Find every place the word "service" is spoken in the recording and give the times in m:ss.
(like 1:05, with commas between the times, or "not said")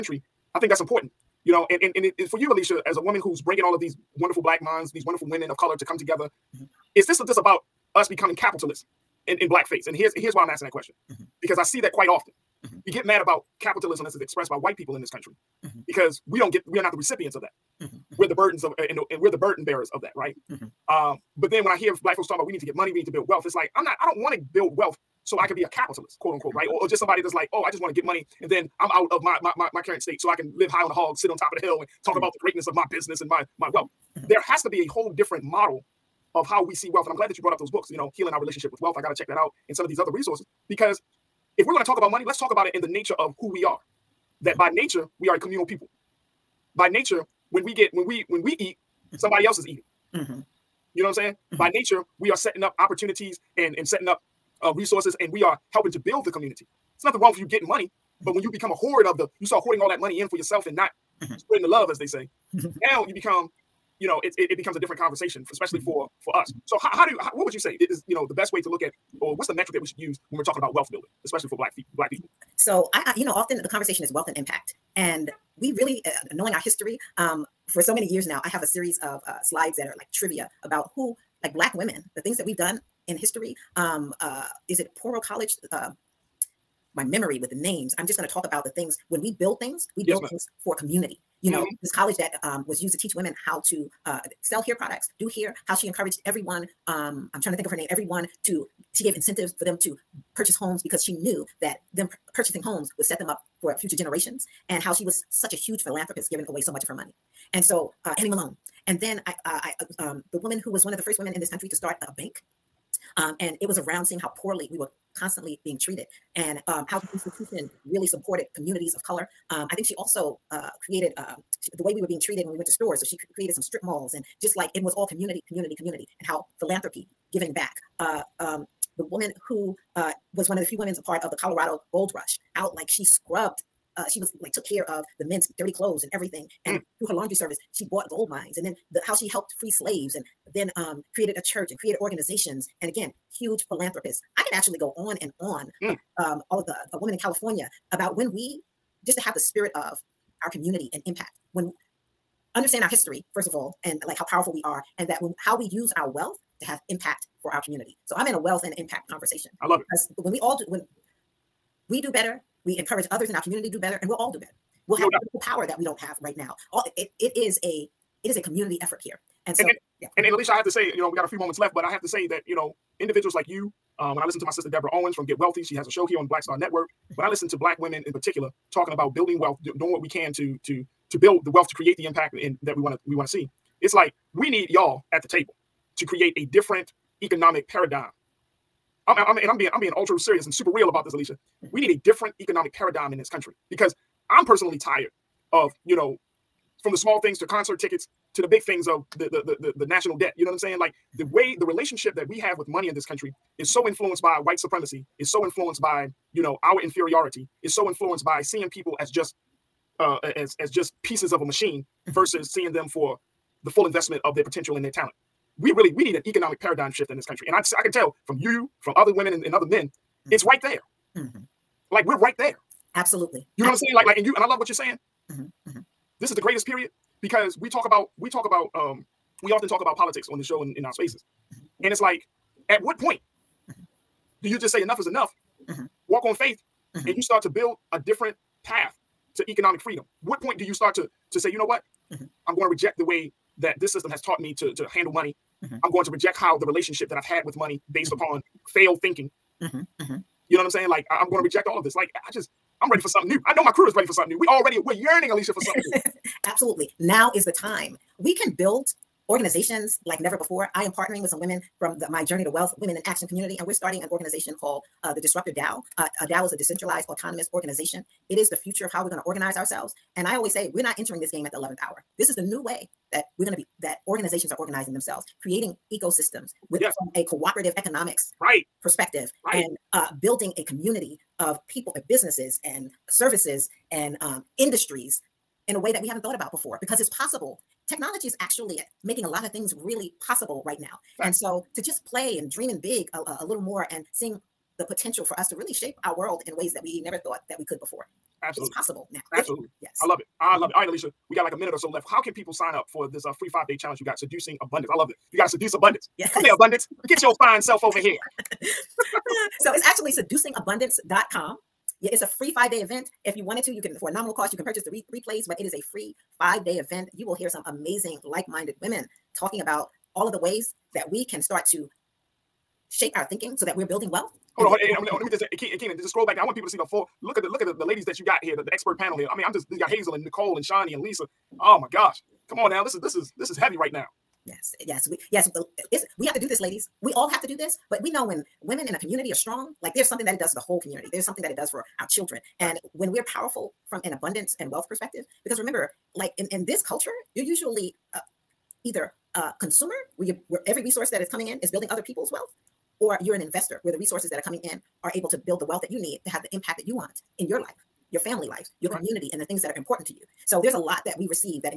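2:17, 4:43.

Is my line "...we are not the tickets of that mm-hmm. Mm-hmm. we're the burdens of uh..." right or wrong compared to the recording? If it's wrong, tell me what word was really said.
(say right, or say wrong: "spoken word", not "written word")
wrong: "recipients", not "tickets".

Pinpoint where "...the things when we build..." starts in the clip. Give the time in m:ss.
1:28.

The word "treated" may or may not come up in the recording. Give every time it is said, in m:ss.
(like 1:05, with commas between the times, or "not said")
1:55, 2:02.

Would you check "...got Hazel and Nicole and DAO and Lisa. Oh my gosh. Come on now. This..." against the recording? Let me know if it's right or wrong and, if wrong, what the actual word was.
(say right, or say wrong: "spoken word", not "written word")
wrong: "Shani", not "DAO".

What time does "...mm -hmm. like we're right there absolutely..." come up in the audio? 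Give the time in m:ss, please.
3:41.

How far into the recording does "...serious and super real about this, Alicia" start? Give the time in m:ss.
3:10.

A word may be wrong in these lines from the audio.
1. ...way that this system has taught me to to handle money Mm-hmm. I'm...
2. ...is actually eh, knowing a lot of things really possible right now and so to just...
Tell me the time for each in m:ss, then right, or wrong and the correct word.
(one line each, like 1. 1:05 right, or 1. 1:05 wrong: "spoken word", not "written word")
1. 4:03 right
2. 4:48 wrong: "making", not "knowing".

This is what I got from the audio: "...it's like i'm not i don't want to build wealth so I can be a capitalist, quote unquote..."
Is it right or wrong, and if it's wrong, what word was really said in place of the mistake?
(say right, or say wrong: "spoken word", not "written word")
right.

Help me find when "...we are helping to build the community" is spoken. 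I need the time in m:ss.
0:55.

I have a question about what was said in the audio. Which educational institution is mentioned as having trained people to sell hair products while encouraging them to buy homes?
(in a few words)
Poro College.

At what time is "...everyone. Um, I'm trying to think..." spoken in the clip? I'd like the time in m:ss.
1:36.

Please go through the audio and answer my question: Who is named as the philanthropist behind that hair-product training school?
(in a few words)
Annie Malone.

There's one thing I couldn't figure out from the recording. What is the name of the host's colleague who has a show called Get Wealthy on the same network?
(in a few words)
Deborah Owens.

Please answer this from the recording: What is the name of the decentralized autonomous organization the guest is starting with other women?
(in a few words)
Disruptor DAO.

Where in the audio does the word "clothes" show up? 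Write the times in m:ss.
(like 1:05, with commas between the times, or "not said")
2:15.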